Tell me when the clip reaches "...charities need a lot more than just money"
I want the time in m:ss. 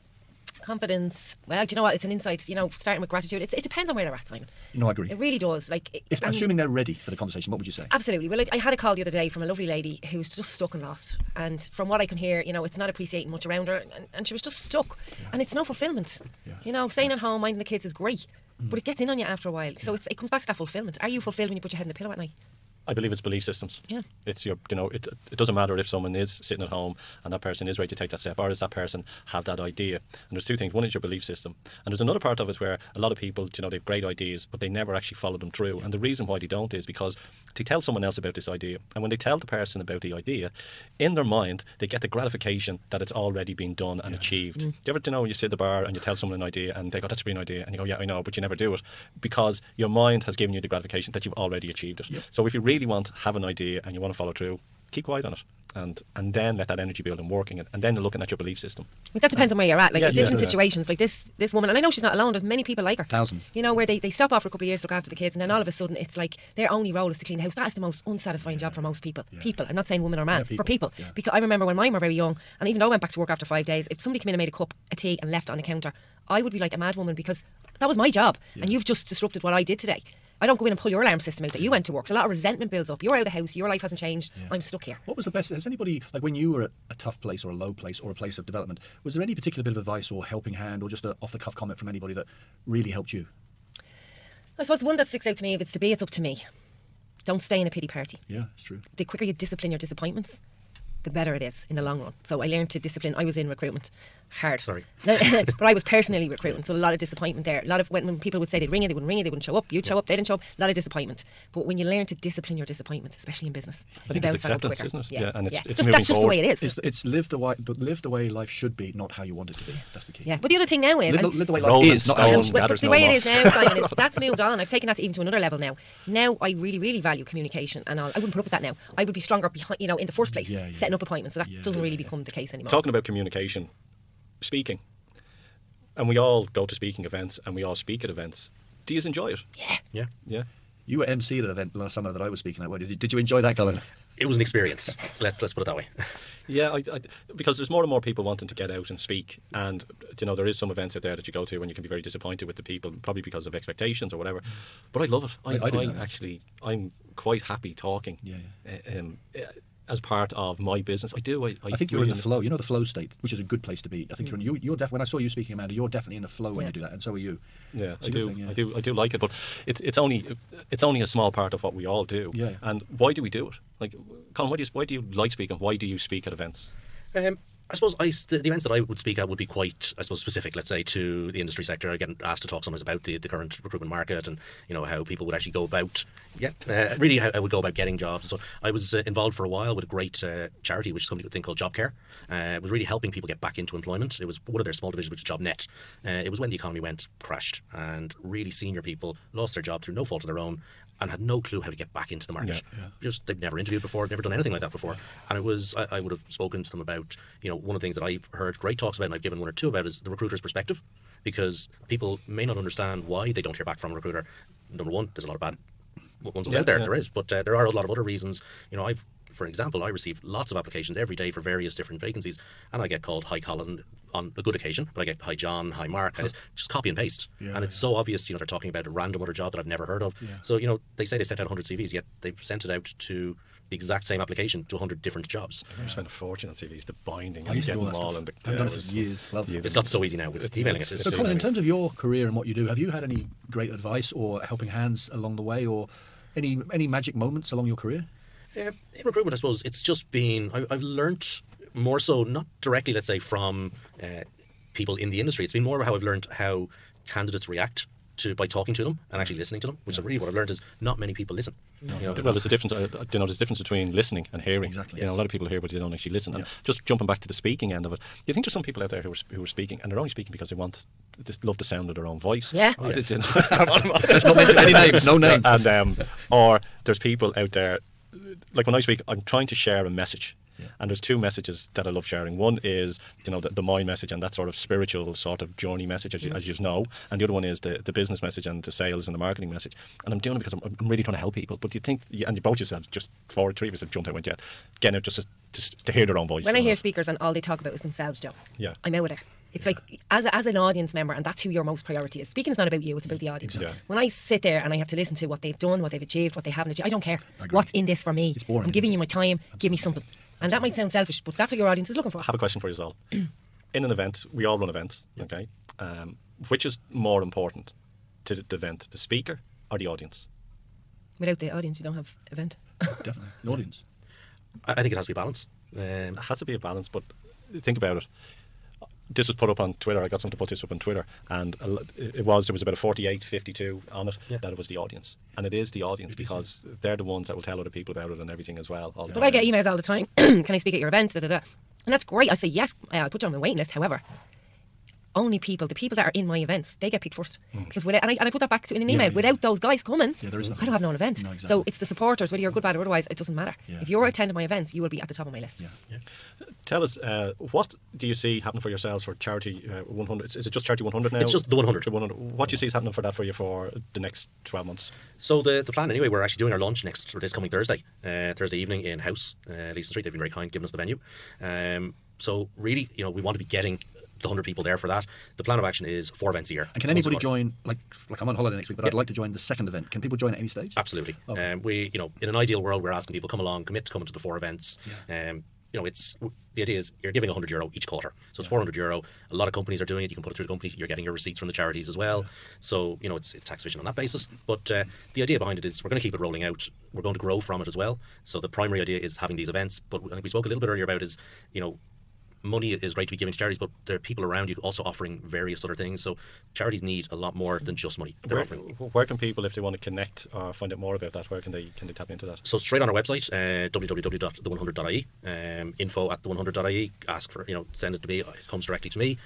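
6:46.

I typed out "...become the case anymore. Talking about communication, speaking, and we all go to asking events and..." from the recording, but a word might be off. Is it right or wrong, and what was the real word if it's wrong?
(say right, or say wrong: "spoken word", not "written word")
wrong: "speaking", not "asking".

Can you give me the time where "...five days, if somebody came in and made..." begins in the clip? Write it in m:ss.
1:13.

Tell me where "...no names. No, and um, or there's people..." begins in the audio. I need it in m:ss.
4:35.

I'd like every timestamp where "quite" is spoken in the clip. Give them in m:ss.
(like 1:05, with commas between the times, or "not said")
2:37, 2:59.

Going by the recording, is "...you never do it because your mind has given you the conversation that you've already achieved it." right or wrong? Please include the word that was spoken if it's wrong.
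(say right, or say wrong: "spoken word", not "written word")
wrong: "gratification", not "conversation".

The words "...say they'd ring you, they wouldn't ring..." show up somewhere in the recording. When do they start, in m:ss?
1:48.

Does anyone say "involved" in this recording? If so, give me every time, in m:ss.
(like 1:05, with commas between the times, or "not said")
3:09.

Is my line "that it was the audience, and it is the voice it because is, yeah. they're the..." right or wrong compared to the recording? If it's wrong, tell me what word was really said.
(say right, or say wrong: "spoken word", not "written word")
wrong: "audience", not "voice".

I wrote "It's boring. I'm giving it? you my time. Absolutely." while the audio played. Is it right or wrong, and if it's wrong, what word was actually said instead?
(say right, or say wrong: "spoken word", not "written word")
right.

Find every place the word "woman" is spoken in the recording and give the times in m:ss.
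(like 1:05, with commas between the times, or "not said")
1:01, 1:10, 1:16.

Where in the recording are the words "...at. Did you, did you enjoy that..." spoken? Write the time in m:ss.
2:22.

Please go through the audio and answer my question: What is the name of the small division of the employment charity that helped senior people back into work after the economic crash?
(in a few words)
JobNet.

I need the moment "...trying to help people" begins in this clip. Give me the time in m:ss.
4:51.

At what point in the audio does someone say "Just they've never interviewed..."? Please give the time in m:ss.
3:23.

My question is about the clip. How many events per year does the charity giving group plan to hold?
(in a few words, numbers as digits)
4.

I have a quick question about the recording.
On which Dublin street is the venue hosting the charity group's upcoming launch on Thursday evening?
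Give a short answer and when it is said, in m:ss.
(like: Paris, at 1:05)
Leeson Street, at 6:09.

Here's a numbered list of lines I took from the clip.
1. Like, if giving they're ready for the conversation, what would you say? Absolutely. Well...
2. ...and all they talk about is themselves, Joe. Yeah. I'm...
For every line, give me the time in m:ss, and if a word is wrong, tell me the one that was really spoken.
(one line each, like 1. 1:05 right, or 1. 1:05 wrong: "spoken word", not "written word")
1. 0:05 wrong: "assuming", not "giving"
2. 4:57 right.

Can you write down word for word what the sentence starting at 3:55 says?
I remember spent spending a fortune on CVs, the binding, I and used to do all that all stuff.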